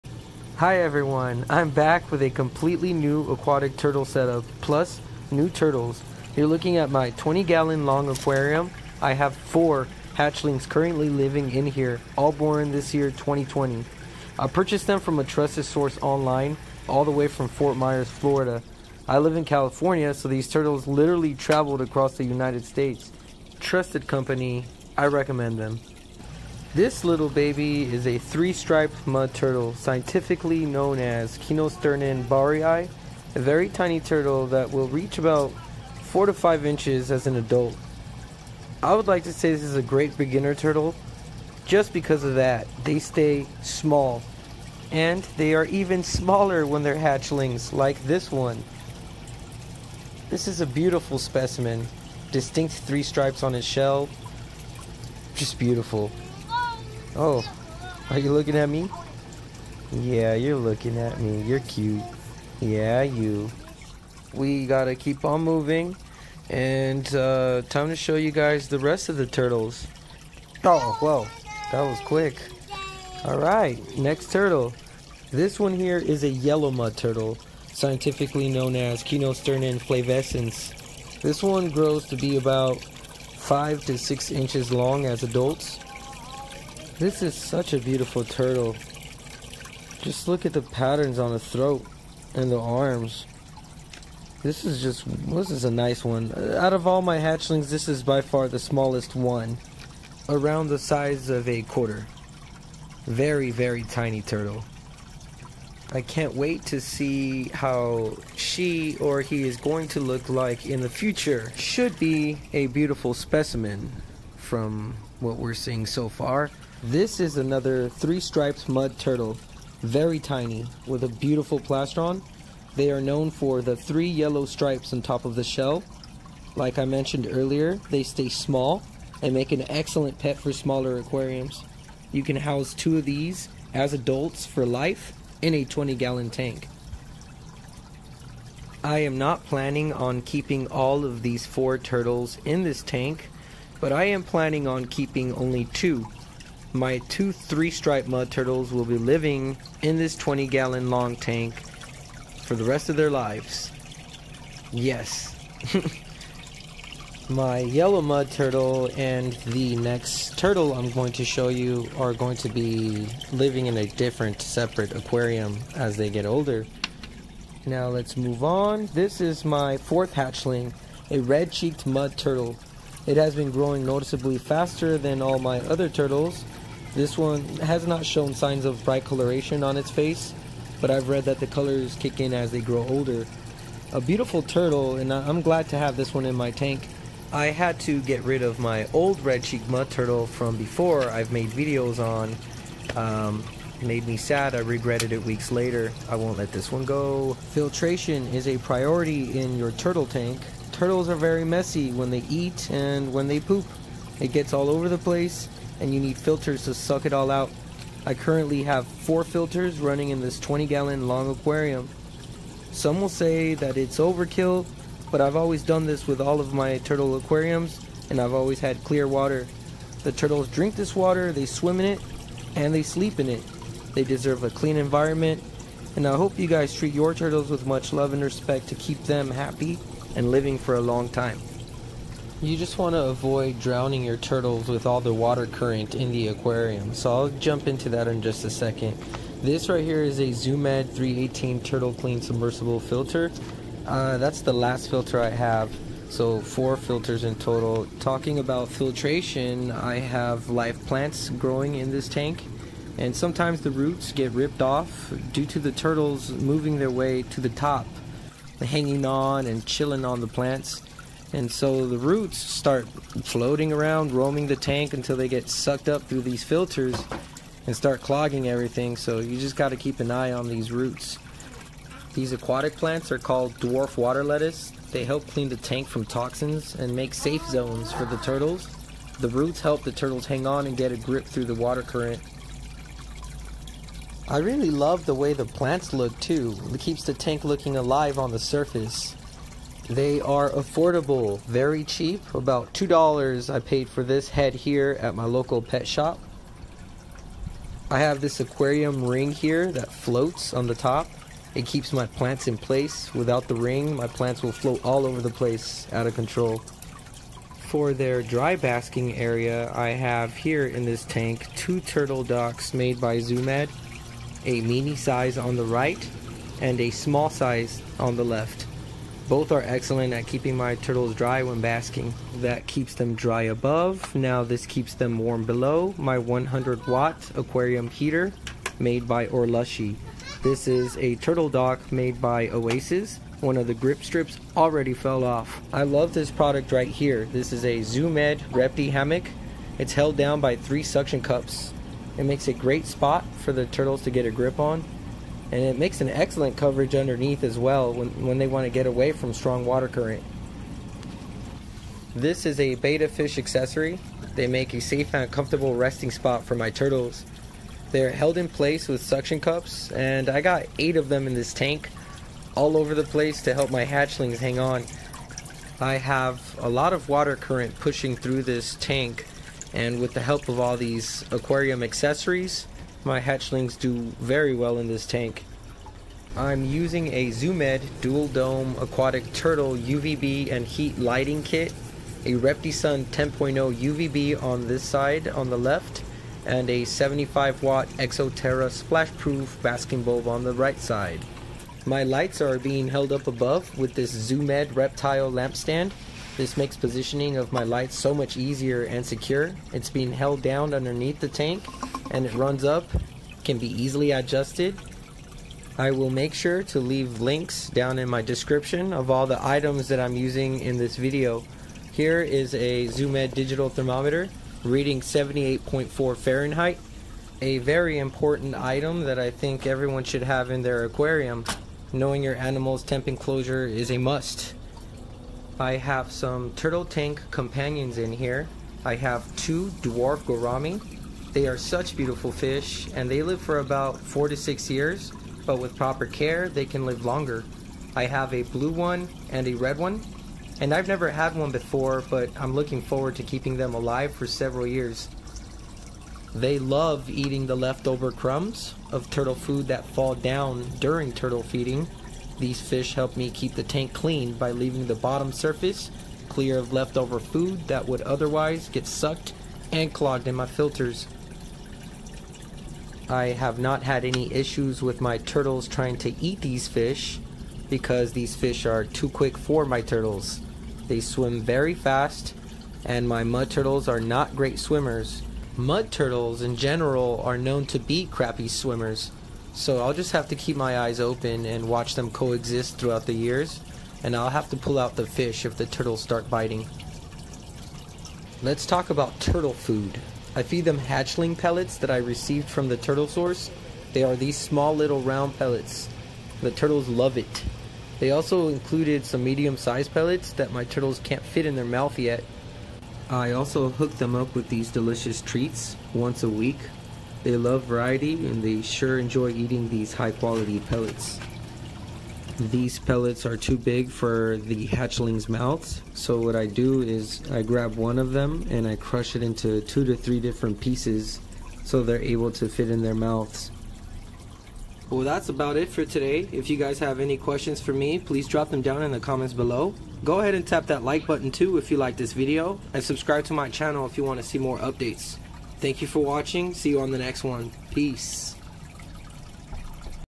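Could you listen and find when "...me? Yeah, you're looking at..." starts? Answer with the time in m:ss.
0:58.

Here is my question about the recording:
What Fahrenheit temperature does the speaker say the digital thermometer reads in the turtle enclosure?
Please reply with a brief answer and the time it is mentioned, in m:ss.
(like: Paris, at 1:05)
78.4, at 6:55.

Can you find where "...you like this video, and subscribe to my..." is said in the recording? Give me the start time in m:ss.
8:51.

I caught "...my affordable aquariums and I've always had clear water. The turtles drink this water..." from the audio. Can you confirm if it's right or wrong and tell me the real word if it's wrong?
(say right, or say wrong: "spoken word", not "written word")
wrong: "turtle", not "affordable".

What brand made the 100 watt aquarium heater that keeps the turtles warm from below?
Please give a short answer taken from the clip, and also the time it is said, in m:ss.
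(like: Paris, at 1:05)
Orlushy, at 5:29.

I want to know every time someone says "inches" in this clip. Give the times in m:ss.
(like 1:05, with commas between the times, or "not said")
0:36, 1:24.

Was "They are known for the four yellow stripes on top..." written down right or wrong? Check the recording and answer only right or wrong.
wrong.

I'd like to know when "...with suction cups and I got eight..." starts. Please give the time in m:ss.
5:58.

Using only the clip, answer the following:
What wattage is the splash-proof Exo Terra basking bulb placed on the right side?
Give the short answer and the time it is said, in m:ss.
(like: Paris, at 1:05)
75 watt, at 6:26.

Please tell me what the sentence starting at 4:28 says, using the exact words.
So you just got to keep an eye on these roots.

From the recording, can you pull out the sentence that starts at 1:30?
Just look at the patterns on the throat and the arms.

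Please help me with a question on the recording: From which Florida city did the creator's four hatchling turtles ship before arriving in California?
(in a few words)
Fort Myers.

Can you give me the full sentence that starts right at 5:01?
It keeps my plants in place.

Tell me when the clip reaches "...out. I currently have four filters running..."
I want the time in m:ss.
3:27.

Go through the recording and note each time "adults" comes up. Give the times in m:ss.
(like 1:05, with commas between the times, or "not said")
0:37, 1:25, 2:13.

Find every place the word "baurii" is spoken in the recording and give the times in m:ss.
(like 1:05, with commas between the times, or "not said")
0:32.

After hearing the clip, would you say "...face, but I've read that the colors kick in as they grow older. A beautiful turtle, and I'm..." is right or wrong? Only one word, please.
right.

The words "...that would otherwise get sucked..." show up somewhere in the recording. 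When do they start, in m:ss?
7:37.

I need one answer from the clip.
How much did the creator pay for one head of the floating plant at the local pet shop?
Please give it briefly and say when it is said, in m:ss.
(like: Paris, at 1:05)
$2, at 4:52.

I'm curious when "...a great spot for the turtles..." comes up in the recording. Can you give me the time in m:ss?
5:42.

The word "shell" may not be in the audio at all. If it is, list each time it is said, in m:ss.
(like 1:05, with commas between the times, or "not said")
0:53, 2:05.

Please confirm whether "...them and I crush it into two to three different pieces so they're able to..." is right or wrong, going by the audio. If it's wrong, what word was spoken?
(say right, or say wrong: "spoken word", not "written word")
right.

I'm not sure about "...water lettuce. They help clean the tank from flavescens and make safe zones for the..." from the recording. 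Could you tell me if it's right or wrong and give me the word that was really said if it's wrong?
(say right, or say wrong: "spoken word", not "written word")
wrong: "toxins", not "flavescens".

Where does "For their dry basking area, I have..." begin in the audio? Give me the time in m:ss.
5:07.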